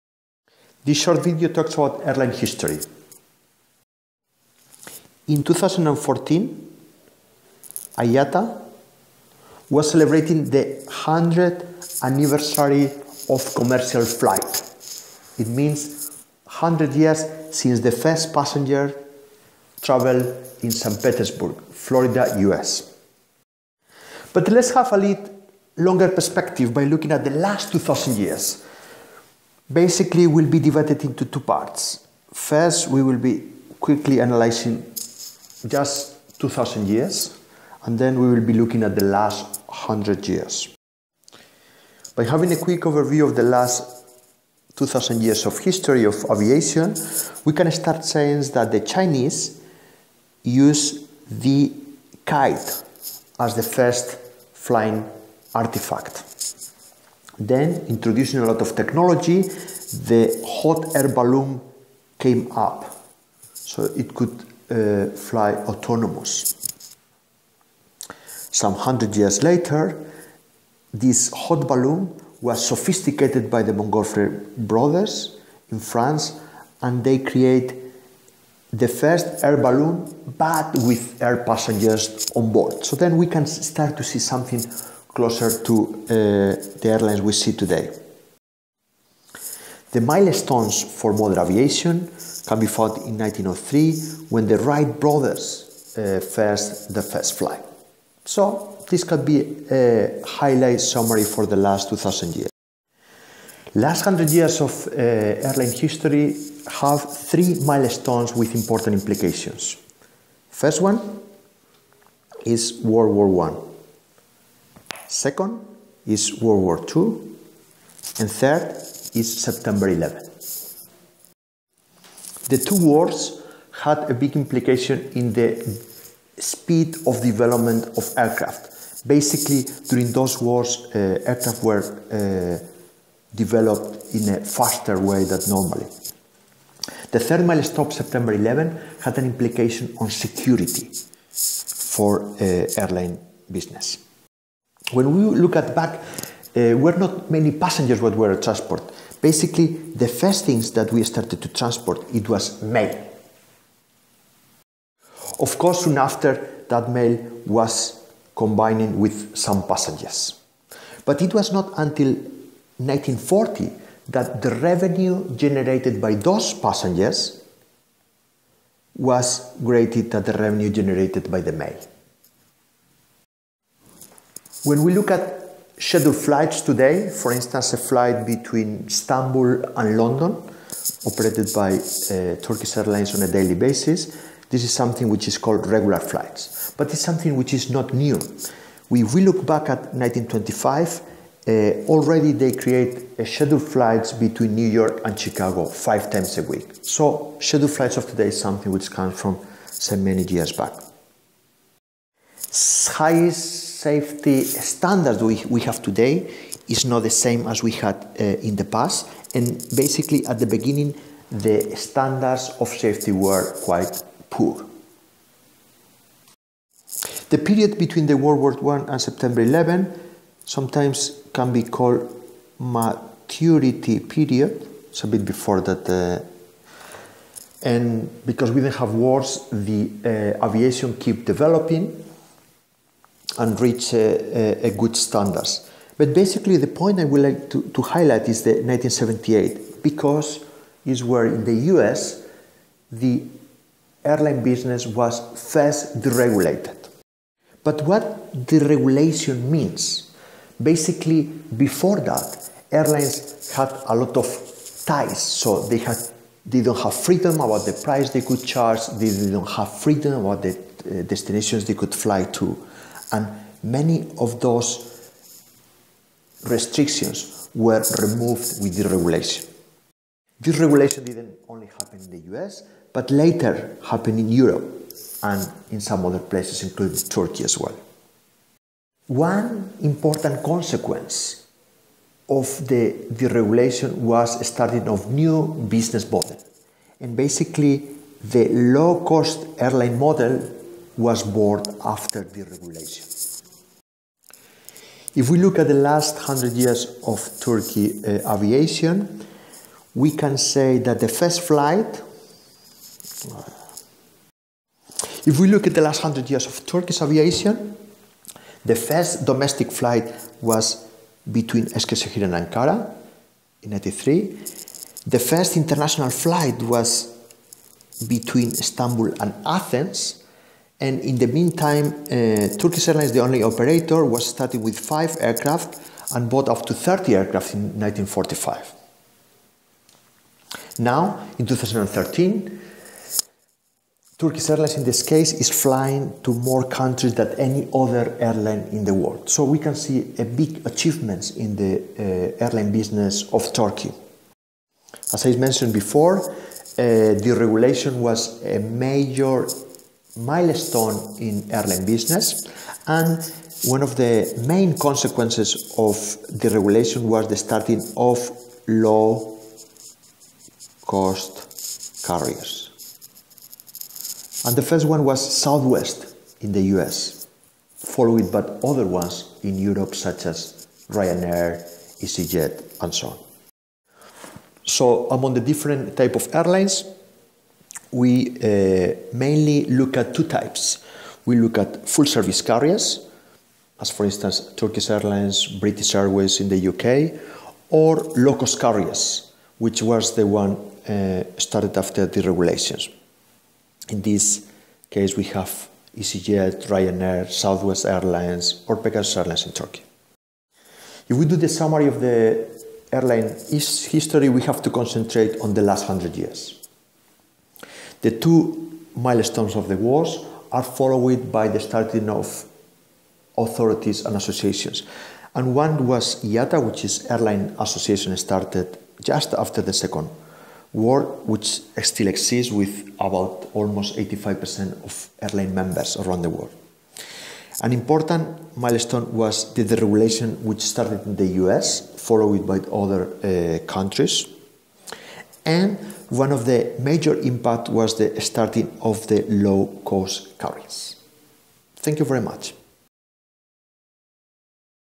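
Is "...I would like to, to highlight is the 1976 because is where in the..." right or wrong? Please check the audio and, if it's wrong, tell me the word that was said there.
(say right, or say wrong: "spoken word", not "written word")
wrong: "1978", not "1976".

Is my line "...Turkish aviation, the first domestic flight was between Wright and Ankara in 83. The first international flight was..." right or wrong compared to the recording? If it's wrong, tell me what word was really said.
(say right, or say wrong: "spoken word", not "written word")
wrong: "Eskişehir", not "Wright".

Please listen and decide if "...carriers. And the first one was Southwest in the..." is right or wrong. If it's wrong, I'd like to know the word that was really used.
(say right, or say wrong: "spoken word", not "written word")
right.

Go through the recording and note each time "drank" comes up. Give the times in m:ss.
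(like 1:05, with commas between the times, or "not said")
not said.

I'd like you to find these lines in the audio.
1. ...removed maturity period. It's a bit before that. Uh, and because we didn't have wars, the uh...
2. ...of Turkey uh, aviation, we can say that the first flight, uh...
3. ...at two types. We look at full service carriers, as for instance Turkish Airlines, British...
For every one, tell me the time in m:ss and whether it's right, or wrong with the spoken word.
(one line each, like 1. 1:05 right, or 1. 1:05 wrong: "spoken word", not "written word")
1. 3:41 wrong: "called", not "removed"
2. 4:57 right
3. 6:19 right.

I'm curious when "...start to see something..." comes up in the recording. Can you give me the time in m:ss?
1:23.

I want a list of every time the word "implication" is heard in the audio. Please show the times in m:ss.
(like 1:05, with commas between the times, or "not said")
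1:48, 2:04, 2:19.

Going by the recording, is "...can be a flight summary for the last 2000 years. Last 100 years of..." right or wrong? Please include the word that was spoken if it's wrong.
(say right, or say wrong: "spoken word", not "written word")
wrong: "highlight", not "flight".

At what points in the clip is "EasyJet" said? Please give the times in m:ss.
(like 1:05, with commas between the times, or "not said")
6:12, 6:35.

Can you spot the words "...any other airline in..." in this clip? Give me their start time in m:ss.
5:37.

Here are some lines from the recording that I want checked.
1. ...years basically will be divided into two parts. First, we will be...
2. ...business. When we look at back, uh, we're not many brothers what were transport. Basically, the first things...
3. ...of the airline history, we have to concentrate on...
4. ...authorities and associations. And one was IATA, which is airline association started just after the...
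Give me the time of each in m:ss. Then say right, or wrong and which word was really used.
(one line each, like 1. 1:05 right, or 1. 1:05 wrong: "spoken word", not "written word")
1. 0:28 right
2. 2:23 wrong: "passengers", not "brothers"
3. 6:41 right
4. 6:53 right.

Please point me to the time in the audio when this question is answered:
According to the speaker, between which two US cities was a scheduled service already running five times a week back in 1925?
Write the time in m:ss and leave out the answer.
3:14.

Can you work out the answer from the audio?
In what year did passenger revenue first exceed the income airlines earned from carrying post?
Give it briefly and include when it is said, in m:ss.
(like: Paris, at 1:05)
1940, at 2:42.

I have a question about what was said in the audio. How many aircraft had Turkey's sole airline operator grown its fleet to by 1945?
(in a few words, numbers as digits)
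30.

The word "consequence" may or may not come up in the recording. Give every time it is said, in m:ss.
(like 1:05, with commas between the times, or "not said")
4:40, 5:54.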